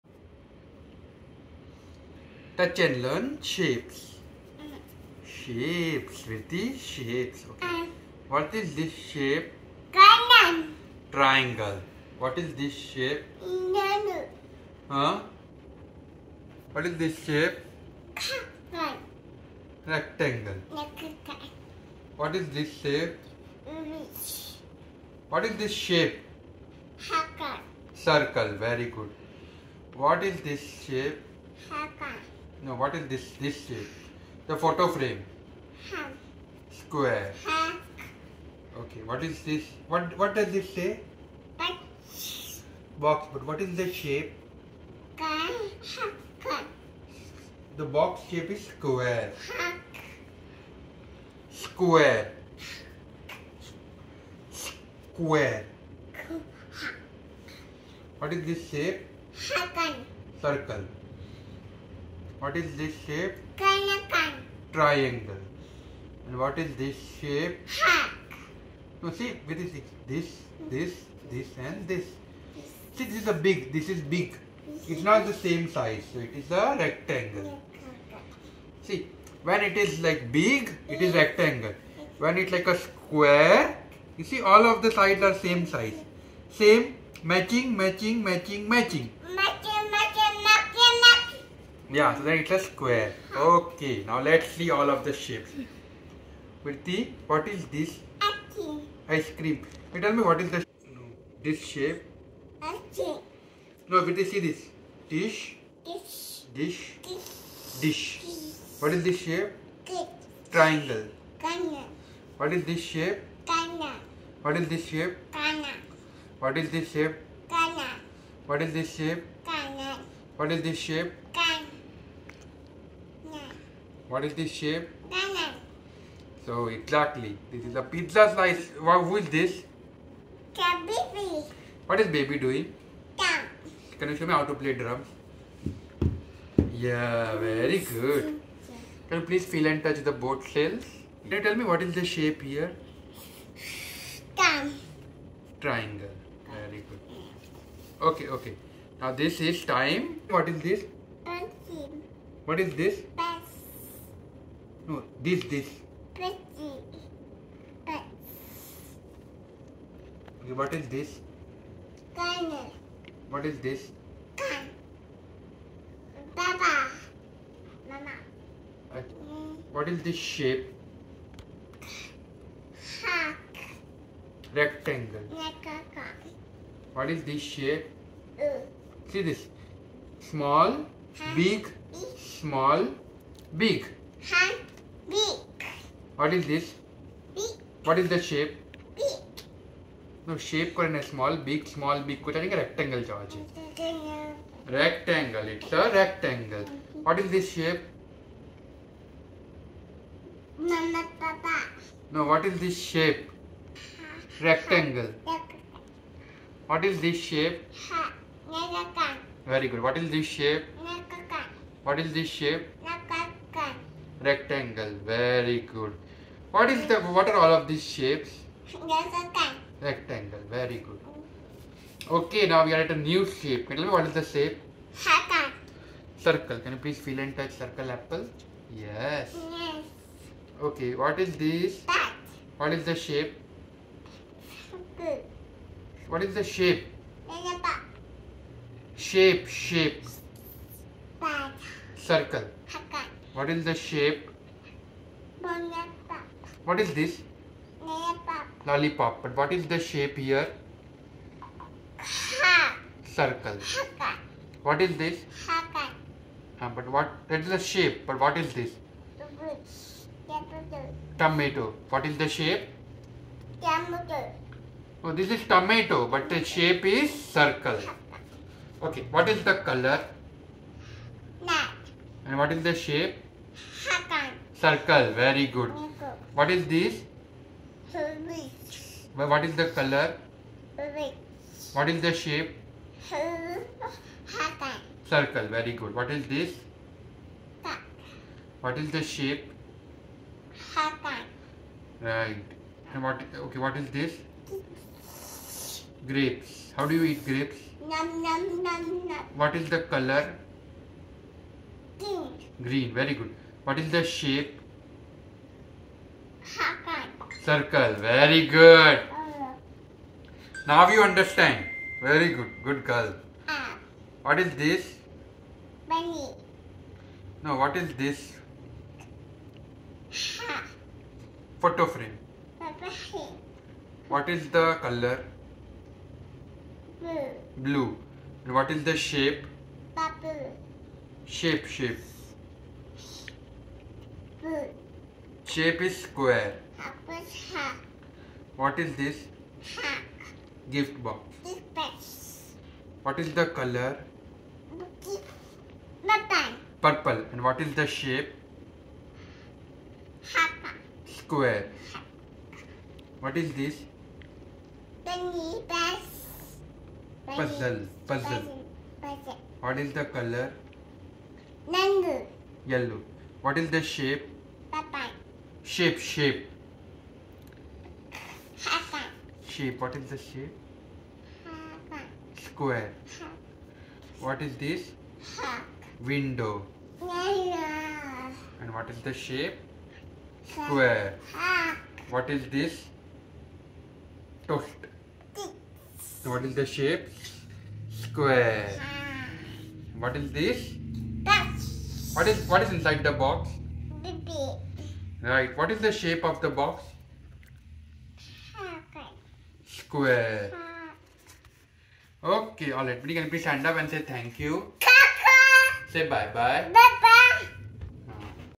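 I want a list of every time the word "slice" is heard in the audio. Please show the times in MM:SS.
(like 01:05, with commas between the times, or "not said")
02:08.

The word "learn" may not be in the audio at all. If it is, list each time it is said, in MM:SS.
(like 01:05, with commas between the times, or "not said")
00:03.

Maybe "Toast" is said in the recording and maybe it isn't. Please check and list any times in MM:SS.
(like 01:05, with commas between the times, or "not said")
06:24.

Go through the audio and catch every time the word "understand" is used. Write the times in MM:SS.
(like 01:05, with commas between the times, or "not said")
05:11.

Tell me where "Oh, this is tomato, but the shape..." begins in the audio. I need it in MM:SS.
04:25.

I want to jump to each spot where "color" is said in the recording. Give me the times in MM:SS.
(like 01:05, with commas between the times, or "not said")
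04:29, 04:39, 04:59, 05:24, 05:43, 06:00.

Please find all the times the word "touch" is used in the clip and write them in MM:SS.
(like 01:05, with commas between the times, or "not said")
00:02, 02:19, 03:47.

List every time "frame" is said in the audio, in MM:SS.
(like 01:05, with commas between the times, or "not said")
00:34, 05:21.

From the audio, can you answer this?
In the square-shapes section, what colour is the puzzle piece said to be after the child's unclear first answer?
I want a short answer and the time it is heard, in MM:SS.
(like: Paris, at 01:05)
Yellow, at 06:02.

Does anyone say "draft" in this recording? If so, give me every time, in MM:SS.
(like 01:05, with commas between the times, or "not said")
not said.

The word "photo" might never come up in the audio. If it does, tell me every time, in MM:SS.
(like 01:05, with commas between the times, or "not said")
00:34, 05:21.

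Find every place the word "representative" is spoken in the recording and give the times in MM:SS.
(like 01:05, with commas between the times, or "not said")
not said.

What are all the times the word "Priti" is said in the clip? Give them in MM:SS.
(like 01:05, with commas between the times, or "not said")
01:36, 01:44.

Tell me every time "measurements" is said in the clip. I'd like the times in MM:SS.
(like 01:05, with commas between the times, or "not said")
not said.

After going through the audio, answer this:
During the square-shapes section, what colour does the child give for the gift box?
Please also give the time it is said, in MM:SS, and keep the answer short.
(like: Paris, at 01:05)
Purple, at 05:46.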